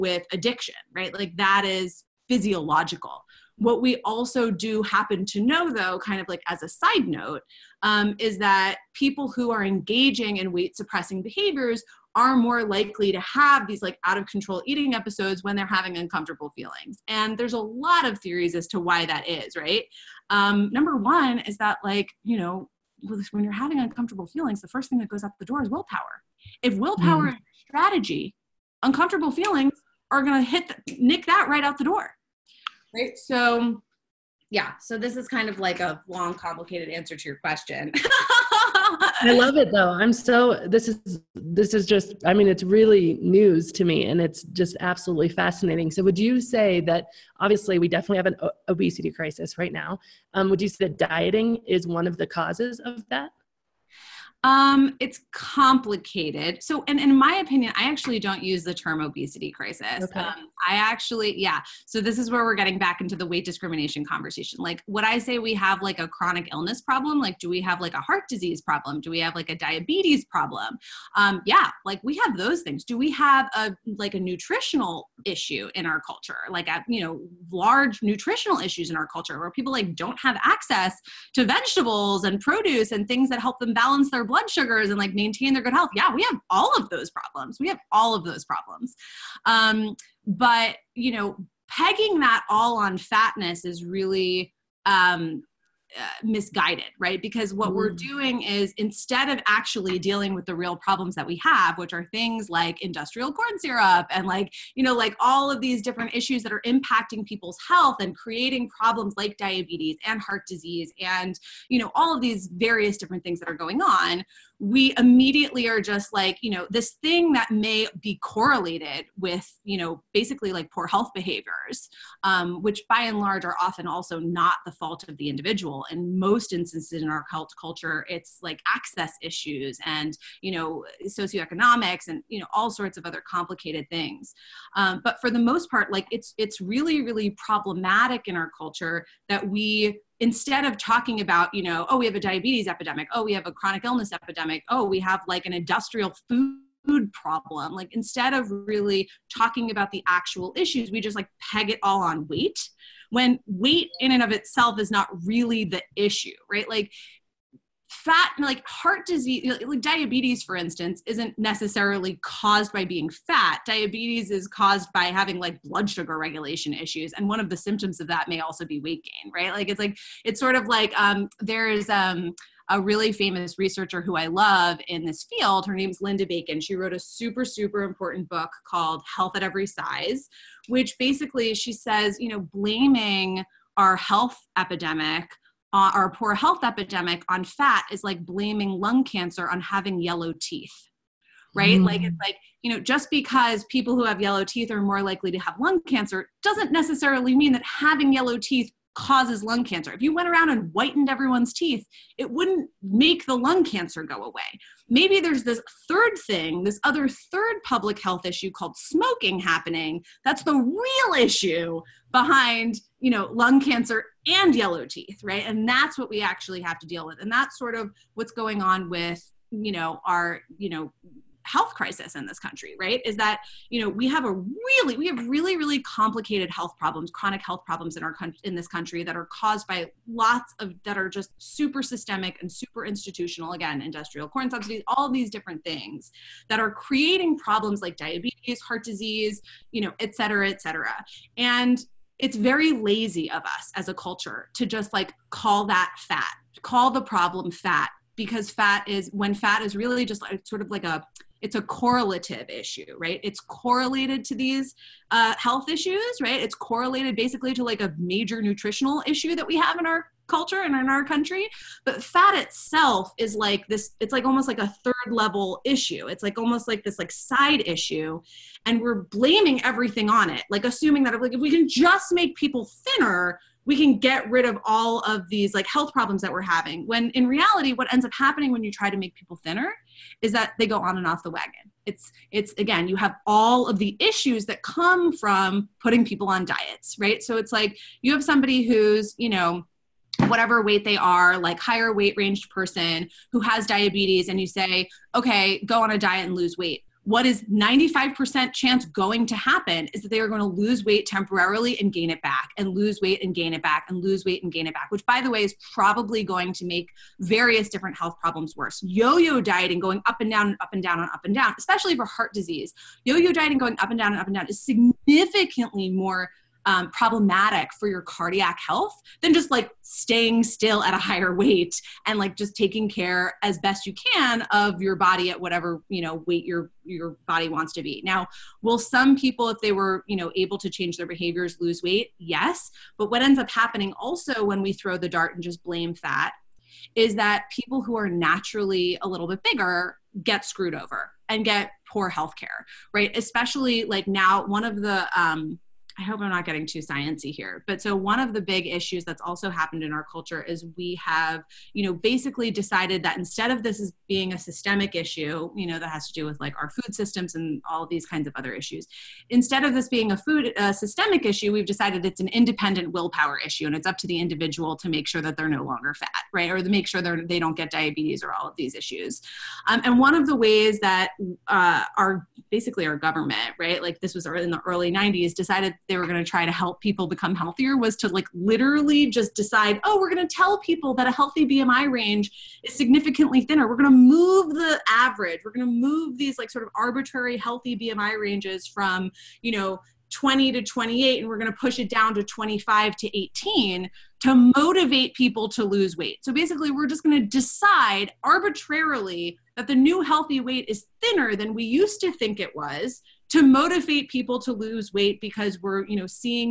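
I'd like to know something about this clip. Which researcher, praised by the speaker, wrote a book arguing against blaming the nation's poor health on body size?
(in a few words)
Linda Bacon.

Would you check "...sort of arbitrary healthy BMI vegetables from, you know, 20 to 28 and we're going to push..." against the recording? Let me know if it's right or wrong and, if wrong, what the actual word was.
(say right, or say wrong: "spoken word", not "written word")
wrong: "ranges", not "vegetables".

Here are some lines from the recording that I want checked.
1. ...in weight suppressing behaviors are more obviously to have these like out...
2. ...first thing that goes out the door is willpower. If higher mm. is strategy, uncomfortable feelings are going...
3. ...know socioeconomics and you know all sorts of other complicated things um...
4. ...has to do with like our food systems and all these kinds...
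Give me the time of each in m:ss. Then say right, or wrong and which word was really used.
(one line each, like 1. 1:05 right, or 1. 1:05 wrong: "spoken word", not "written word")
1. 0:10 wrong: "likely", not "obviously"
2. 0:24 wrong: "willpower", not "higher"
3. 2:10 right
4. 5:55 right.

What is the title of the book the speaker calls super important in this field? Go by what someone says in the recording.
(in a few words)
Health at Every Size.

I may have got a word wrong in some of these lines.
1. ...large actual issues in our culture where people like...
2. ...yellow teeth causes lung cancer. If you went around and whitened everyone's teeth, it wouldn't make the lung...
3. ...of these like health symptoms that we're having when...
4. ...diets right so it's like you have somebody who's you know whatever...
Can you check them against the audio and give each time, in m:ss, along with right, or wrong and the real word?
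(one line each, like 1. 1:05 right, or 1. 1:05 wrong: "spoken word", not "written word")
1. 1:17 wrong: "nutritional", not "actual"
2. 3:18 right
3. 4:34 wrong: "problems", not "symptoms"
4. 4:46 right.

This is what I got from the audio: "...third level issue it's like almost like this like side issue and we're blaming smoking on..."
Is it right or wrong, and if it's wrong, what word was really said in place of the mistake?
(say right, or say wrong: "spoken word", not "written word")
wrong: "everything", not "smoking".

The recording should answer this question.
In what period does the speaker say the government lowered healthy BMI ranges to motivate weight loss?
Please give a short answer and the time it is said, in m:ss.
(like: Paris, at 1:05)
early 90s, at 6:14.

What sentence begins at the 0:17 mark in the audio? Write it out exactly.
And there's a lot of theories as to why that is, right?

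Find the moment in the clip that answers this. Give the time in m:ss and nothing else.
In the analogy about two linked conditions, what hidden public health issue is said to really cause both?
3:28.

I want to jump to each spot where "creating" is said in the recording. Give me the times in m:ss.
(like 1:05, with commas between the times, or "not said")
1:48, 3:56.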